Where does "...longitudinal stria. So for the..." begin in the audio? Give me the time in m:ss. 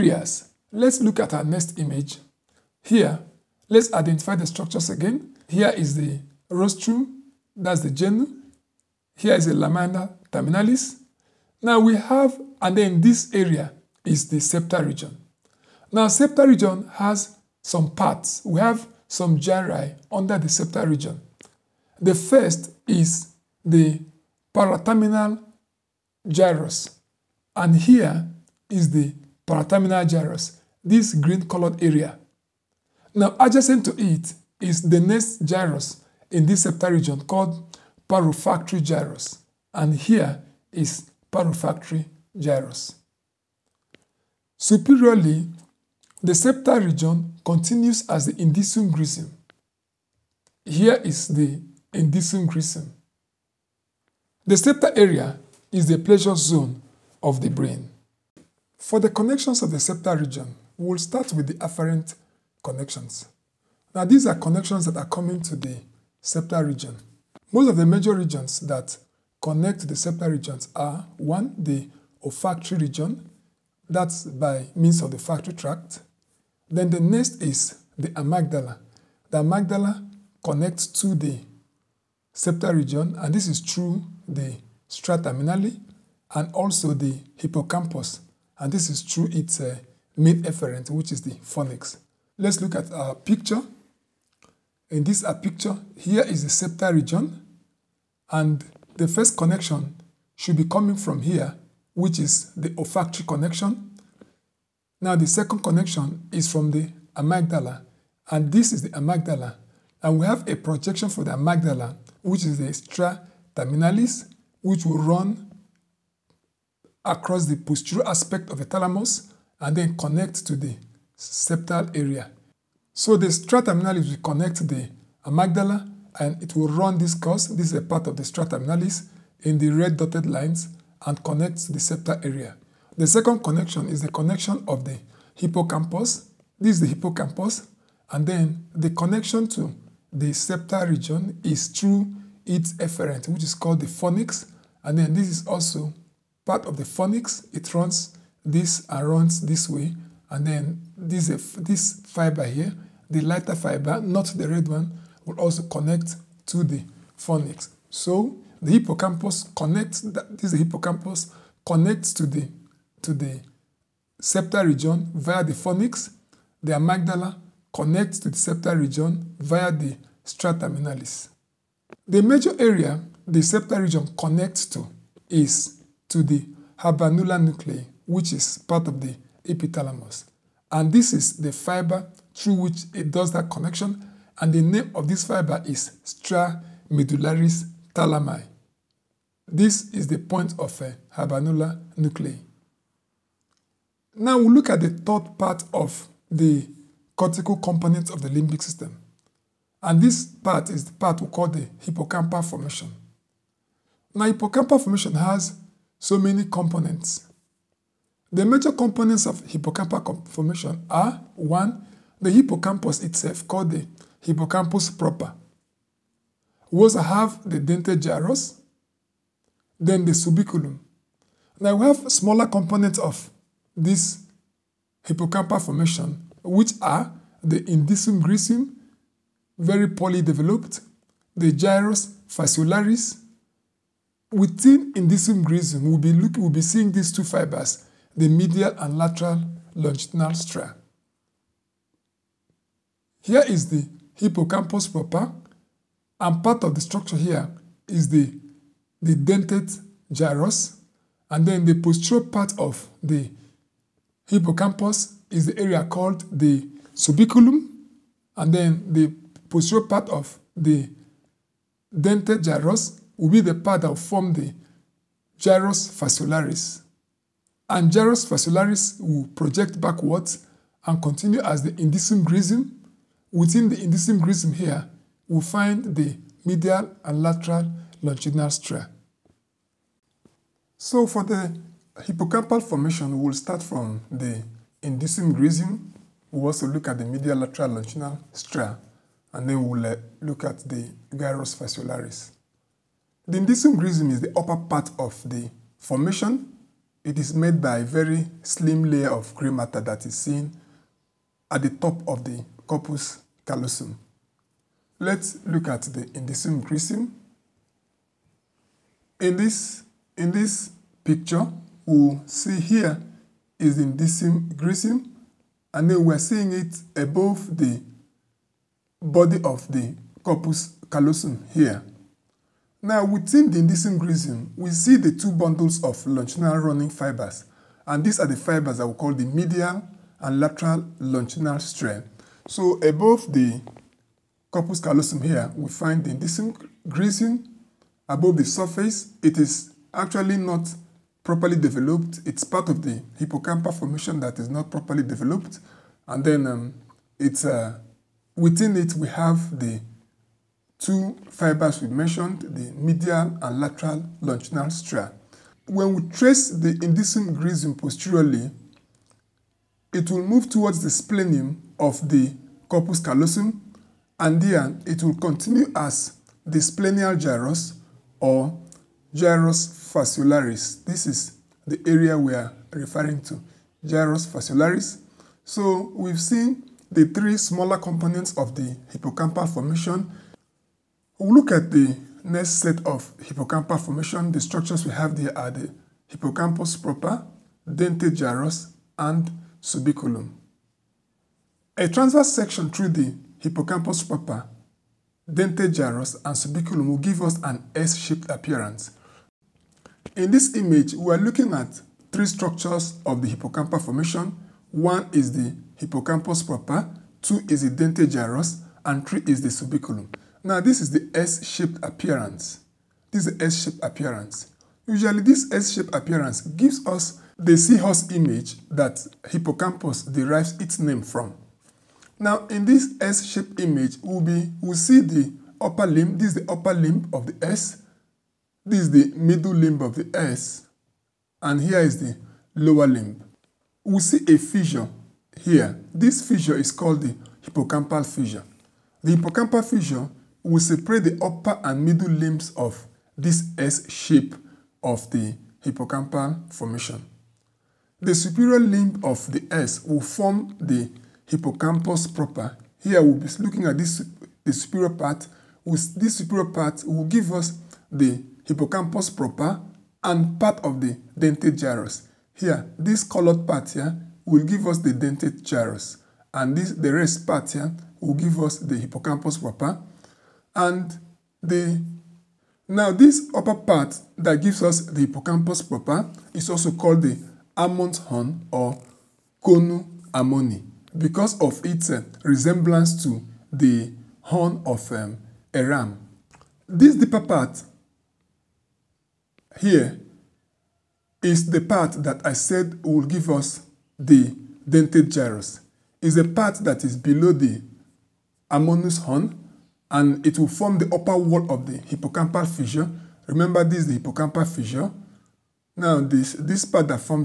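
4:38.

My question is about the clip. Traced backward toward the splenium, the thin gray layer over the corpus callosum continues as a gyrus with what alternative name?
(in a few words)
Splenial gyrus.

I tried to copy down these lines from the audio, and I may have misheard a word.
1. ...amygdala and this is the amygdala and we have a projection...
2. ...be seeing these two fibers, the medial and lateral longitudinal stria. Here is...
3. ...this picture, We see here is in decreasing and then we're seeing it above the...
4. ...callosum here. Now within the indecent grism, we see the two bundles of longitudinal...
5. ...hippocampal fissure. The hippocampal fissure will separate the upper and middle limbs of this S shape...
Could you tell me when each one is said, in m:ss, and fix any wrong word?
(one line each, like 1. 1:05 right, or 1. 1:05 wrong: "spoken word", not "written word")
1. 1:47 right
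2. 3:56 right
3. 5:10 right
4. 5:20 right
5. 7:17 right.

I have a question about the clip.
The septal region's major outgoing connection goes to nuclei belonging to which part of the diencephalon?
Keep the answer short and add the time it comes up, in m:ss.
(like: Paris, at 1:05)
Epithalamus, at 2:59.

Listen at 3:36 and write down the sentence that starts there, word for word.
We also have the dentate gyrus, then the subiculum.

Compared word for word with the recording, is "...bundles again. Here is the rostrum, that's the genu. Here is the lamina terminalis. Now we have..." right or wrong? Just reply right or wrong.
wrong.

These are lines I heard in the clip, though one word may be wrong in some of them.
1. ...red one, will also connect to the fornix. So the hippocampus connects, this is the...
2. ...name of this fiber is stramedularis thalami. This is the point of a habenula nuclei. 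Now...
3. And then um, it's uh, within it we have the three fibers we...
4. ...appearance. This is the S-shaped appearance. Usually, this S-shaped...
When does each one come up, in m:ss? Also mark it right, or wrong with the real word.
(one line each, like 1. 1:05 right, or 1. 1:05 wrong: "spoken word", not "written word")
1. 2:34 right
2. 3:04 right
3. 5:46 wrong: "two", not "three"
4. 6:51 right.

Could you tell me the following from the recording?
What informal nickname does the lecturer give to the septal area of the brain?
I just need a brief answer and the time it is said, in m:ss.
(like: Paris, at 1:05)
Pleasure zone, at 0:55.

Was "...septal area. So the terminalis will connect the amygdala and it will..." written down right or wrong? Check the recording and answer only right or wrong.
right.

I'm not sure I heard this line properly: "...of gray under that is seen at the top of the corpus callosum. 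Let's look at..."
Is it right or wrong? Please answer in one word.
wrong.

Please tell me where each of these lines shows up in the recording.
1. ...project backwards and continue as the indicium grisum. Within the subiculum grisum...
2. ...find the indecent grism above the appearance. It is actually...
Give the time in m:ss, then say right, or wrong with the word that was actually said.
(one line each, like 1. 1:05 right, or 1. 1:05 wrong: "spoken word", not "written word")
1. 4:29 wrong: "indicium", not "subiculum"
2. 5:35 wrong: "surface", not "appearance".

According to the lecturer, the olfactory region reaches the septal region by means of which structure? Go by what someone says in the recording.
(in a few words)
Olfactory tract.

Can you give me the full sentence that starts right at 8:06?
This deeper part Here is the part that I said will give us the dentate gyrus.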